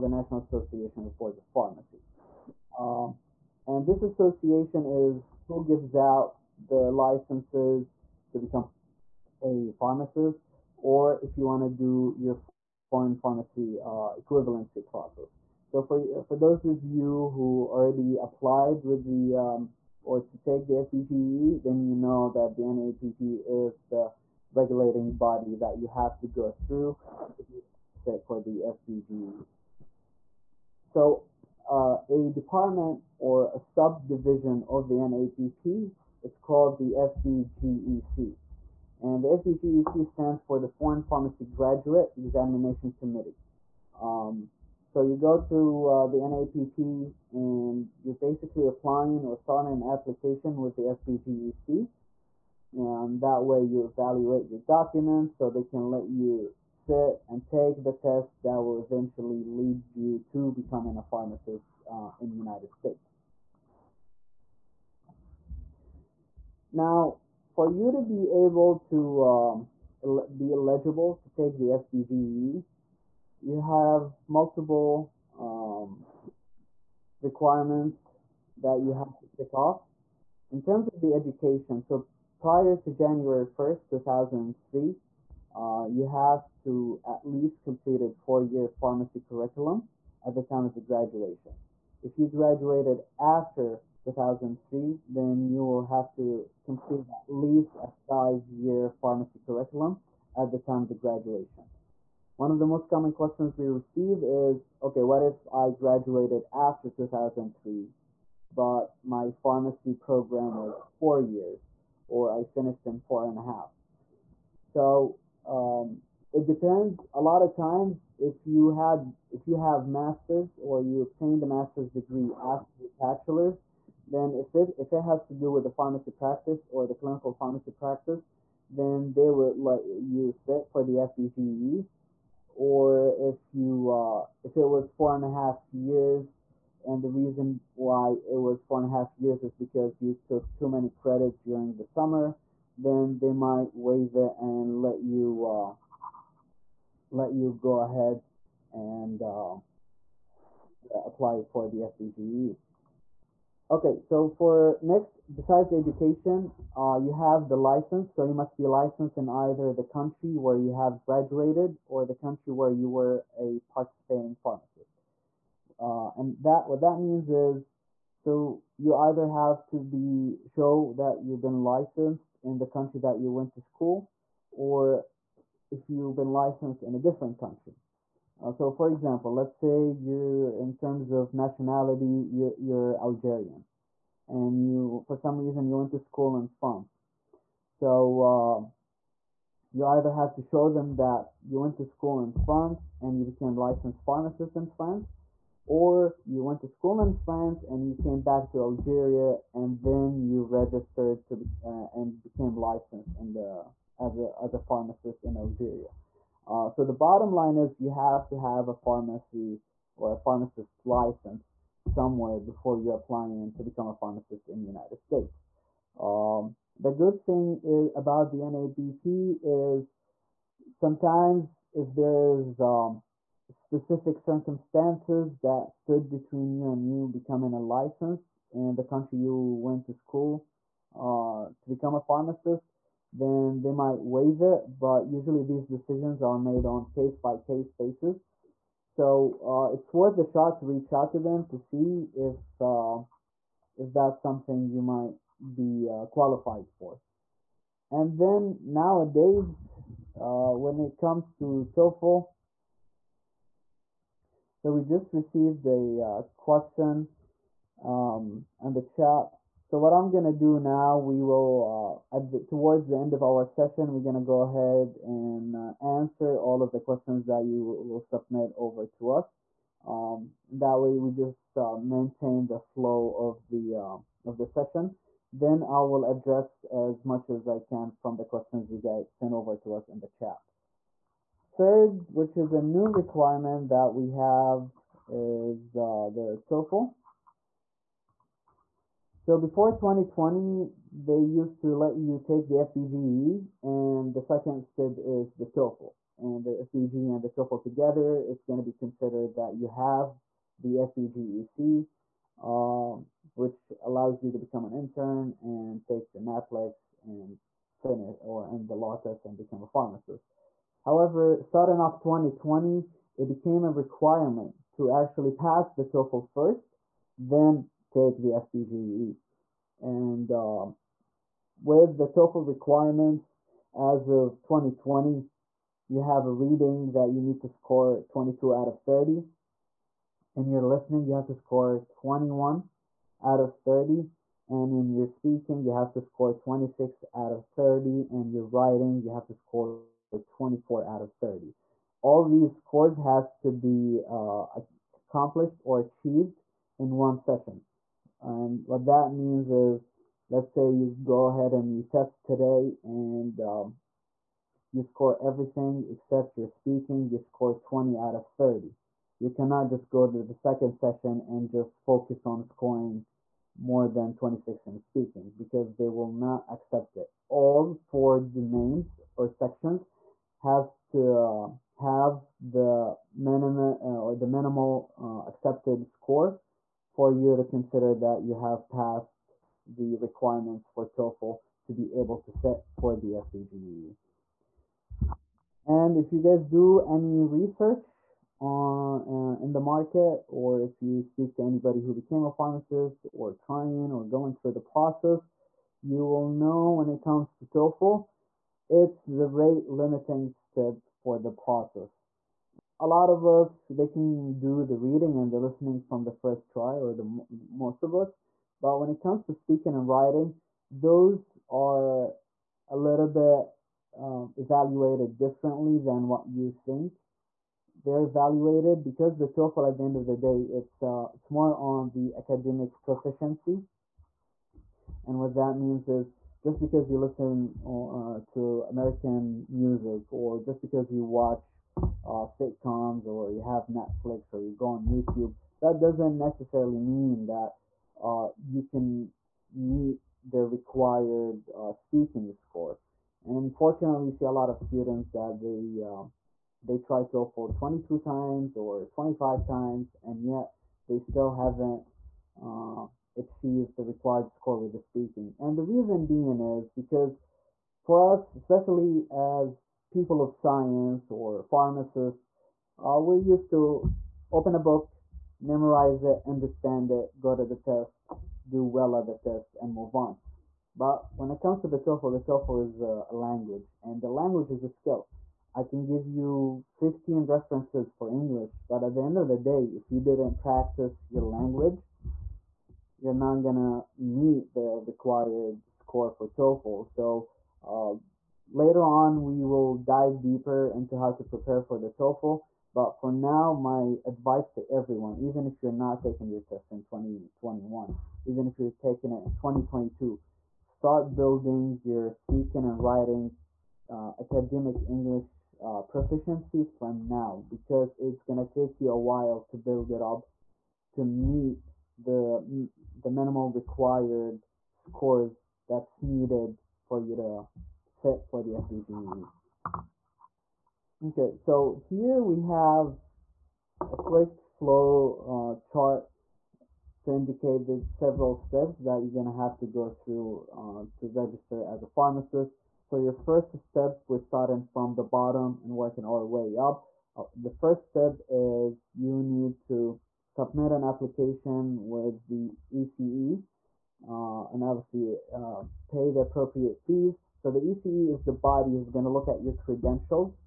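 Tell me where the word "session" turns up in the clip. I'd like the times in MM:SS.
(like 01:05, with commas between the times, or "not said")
04:23, 04:34, 05:47, 06:00.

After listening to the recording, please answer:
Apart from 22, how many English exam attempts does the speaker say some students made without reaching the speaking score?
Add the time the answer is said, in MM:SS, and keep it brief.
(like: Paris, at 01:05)
25, at 07:28.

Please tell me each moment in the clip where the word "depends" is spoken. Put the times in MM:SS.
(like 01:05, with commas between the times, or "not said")
01:56.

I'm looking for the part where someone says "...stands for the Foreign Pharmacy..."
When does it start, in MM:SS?
00:40.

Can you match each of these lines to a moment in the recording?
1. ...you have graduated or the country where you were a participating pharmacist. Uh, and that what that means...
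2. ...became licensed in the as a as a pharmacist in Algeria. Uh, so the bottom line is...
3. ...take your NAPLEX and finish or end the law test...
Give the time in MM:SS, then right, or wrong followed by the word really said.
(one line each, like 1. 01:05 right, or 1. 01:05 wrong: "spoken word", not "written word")
1. 02:40 right
2. 03:22 right
3. 05:05 right.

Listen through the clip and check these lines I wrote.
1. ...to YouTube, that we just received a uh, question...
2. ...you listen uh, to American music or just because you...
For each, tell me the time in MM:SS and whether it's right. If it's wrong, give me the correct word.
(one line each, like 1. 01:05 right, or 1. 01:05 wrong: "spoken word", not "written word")
1. 04:11 wrong: "TOEFL", not "YouTube"
2. 07:06 right.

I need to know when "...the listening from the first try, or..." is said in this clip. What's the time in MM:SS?
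06:45.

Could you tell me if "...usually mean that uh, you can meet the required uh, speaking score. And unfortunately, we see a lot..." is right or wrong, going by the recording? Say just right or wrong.
wrong.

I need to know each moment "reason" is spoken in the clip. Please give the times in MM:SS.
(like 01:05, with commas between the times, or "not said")
02:17, 03:05, 07:35.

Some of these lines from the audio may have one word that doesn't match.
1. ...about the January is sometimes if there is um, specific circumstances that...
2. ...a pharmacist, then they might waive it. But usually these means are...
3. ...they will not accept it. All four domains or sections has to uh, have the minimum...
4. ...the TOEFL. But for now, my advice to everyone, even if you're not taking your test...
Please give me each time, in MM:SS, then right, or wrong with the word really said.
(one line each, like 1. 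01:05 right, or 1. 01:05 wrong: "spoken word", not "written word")
1. 03:37 wrong: "NABP", not "January"
2. 03:51 wrong: "decisions", not "means"
3. 06:05 right
4. 08:11 right.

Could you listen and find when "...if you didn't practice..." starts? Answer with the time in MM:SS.
07:59.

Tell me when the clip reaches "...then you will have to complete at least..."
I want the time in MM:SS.
01:35.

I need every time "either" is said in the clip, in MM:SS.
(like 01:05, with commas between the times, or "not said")
02:39, 02:48, 03:09.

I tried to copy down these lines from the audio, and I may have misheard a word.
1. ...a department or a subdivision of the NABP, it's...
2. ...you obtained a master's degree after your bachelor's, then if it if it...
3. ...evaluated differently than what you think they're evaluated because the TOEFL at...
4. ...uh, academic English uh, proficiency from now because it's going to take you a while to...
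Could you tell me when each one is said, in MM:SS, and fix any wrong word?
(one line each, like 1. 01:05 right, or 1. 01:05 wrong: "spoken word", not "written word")
1. 00:32 right
2. 02:00 right
3. 06:54 right
4. 08:23 right.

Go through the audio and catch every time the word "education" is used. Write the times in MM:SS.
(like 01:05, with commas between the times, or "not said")
01:21, 02:35.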